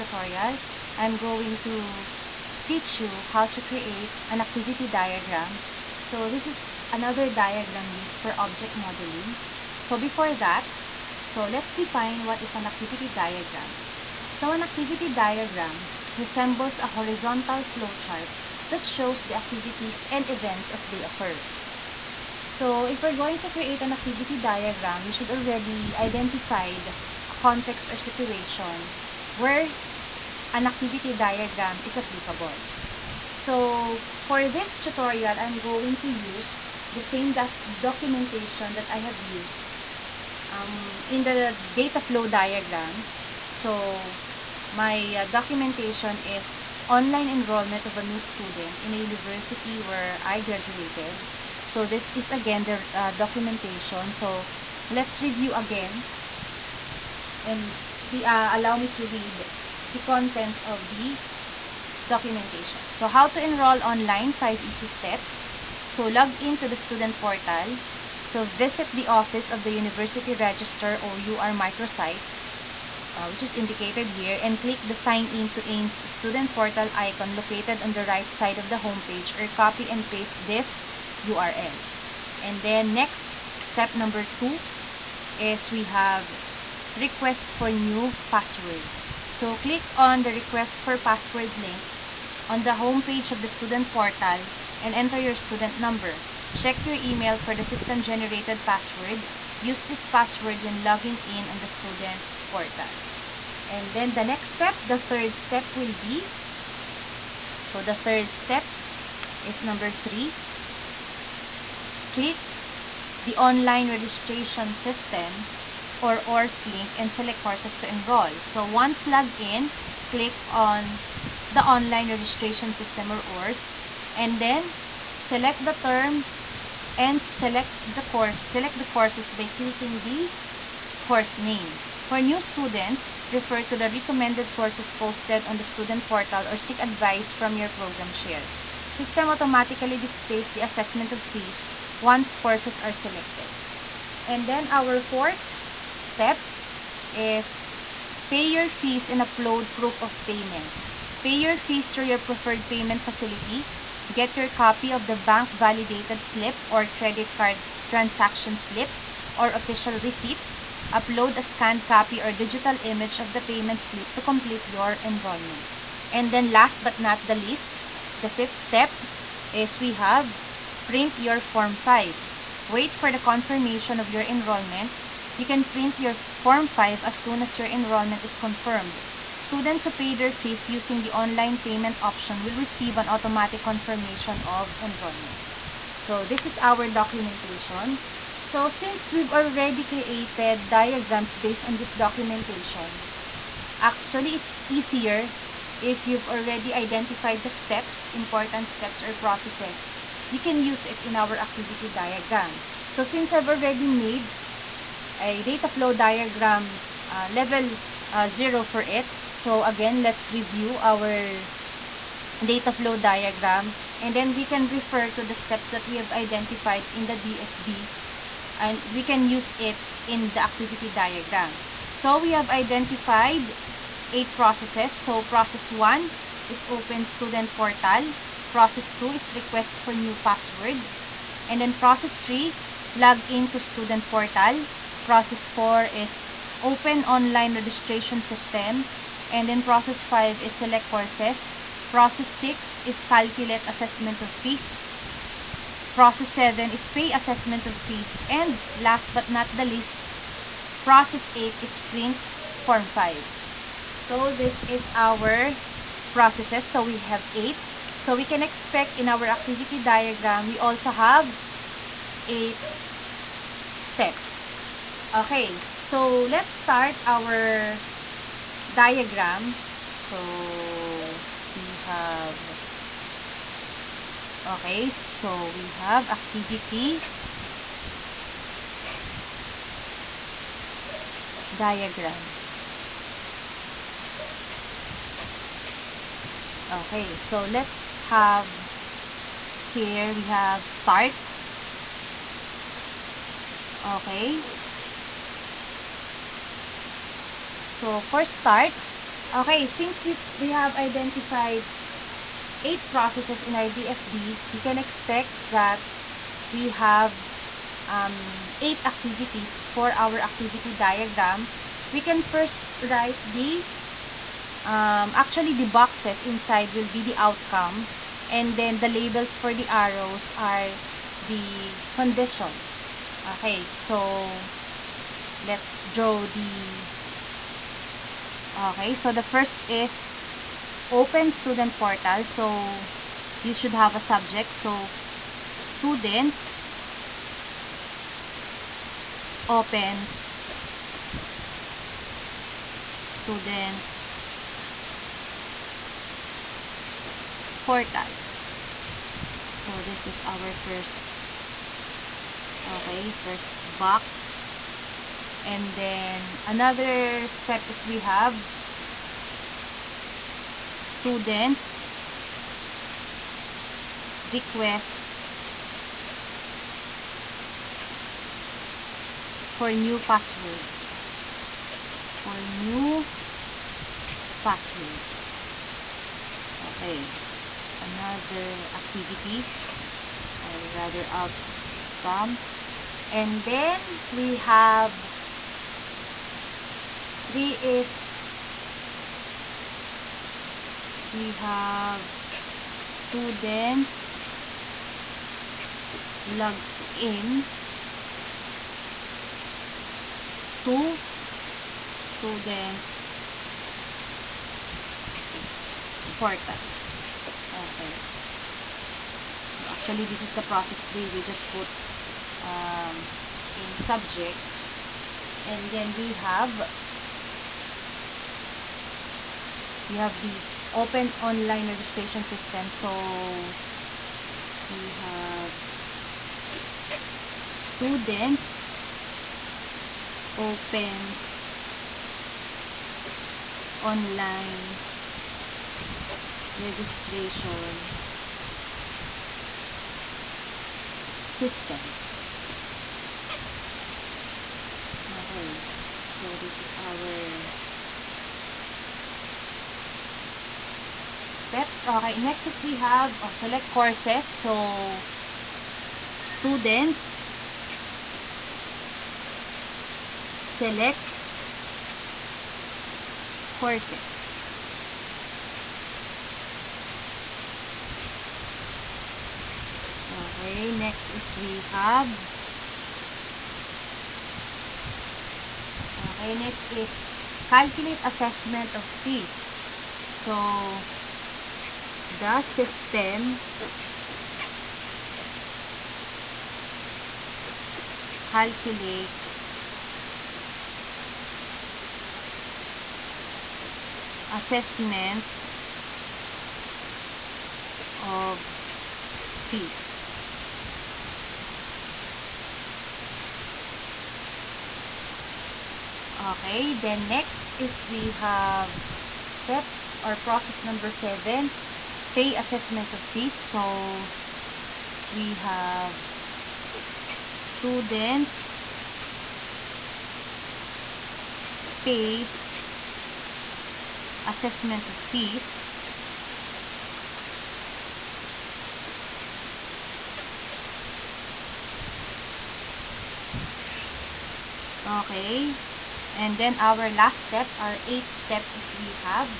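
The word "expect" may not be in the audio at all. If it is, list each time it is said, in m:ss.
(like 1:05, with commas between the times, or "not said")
4:18, 5:04.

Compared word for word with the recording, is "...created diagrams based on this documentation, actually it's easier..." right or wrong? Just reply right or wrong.
right.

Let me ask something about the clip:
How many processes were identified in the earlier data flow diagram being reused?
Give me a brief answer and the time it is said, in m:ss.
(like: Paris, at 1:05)
8, at 3:44.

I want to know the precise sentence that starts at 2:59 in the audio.
Students who pay their fees using the online payment option will receive an automatic confirmation of enrollment.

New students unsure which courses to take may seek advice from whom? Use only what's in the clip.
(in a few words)
program chair.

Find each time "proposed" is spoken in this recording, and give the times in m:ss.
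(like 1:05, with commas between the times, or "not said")
not said.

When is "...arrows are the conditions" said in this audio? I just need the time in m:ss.
5:19.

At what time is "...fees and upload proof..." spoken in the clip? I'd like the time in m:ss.
2:28.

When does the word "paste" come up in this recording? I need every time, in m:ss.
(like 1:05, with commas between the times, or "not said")
1:20.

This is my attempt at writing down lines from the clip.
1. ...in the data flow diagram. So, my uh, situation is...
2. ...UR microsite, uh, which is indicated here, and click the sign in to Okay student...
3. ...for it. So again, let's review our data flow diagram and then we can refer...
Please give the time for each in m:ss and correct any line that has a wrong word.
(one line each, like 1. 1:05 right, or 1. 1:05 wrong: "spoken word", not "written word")
1. 0:41 wrong: "documentation", not "situation"
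2. 1:11 wrong: "AIMS", not "Okay"
3. 3:28 right.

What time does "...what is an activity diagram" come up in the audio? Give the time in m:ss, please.
0:12.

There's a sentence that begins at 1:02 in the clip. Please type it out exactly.
So how to enroll online, five easy steps.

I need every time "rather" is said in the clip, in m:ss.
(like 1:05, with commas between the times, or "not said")
6:20.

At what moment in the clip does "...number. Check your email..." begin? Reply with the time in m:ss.
1:35.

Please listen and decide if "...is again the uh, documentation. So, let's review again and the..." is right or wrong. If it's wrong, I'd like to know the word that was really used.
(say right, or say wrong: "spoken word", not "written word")
right.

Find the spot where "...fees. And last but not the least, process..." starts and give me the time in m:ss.
4:07.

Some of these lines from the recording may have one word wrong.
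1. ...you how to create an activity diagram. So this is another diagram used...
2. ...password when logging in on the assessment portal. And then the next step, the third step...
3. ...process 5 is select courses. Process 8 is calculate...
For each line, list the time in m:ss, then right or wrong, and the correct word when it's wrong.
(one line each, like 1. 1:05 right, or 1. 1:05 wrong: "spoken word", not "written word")
1. 0:03 right
2. 1:40 wrong: "student", not "assessment"
3. 3:59 wrong: "6", not "8".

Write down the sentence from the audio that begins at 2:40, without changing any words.
Upload a scanned copy or digital image of the payment slip to complete your enrollment.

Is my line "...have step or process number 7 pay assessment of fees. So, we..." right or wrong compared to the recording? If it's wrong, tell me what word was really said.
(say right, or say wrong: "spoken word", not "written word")
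right.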